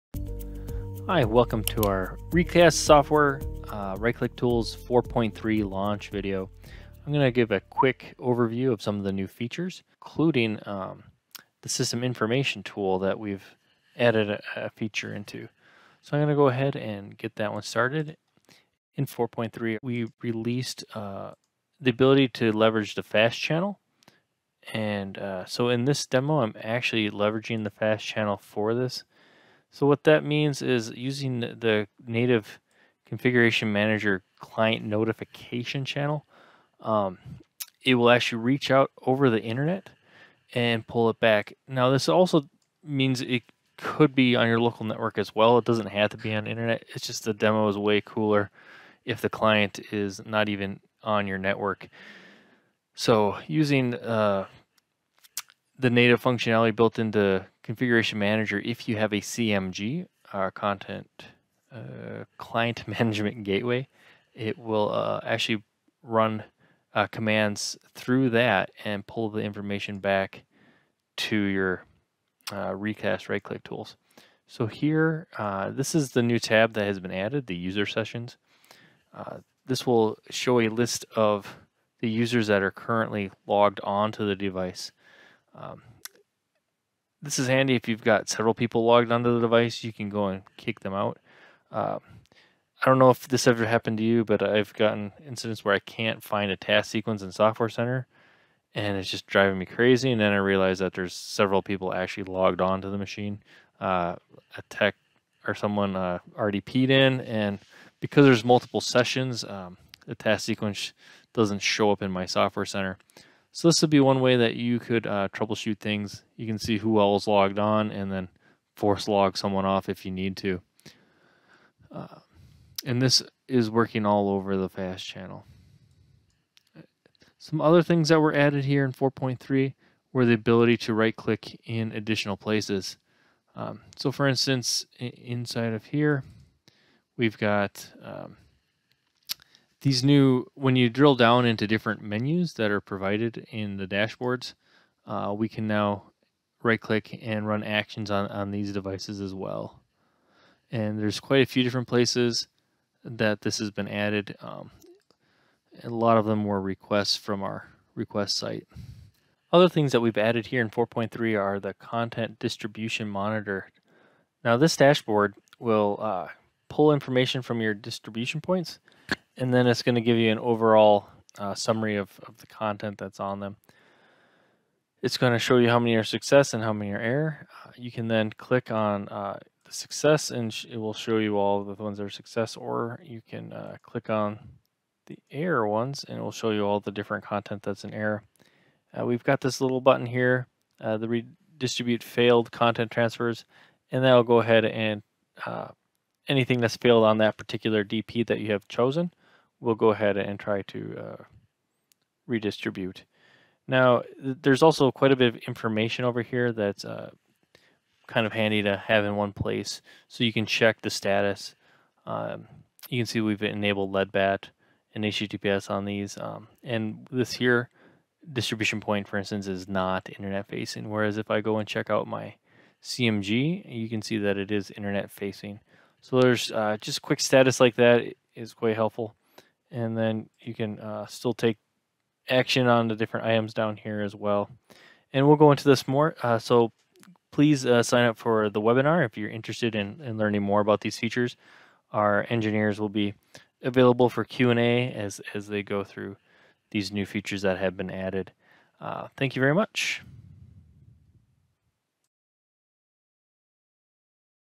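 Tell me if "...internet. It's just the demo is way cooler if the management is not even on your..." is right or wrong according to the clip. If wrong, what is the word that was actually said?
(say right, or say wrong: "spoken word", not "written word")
wrong: "client", not "management".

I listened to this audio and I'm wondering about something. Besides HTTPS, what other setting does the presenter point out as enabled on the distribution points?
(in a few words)
LEDBAT.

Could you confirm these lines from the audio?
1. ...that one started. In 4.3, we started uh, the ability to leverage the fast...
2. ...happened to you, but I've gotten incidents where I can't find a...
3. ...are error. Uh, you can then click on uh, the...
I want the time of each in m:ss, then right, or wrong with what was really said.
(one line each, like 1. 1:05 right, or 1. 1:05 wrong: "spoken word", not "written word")
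1. 0:17 wrong: "released", not "started"
2. 1:33 right
3. 2:56 right.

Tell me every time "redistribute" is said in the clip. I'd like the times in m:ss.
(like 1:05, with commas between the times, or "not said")
3:11, 3:22.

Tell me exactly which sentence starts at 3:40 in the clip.
Whereas if I go and check out my CMG, you can see that it is internet facing.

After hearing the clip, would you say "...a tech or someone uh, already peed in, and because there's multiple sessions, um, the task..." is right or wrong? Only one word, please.
right.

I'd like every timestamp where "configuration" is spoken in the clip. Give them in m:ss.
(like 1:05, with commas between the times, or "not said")
0:33, 0:57.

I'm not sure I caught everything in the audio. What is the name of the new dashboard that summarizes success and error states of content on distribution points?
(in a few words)
content distribution monitor.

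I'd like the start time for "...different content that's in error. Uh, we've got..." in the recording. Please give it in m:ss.
3:06.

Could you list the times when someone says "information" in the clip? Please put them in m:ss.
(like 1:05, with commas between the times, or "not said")
0:12, 1:09, 2:46, 3:25.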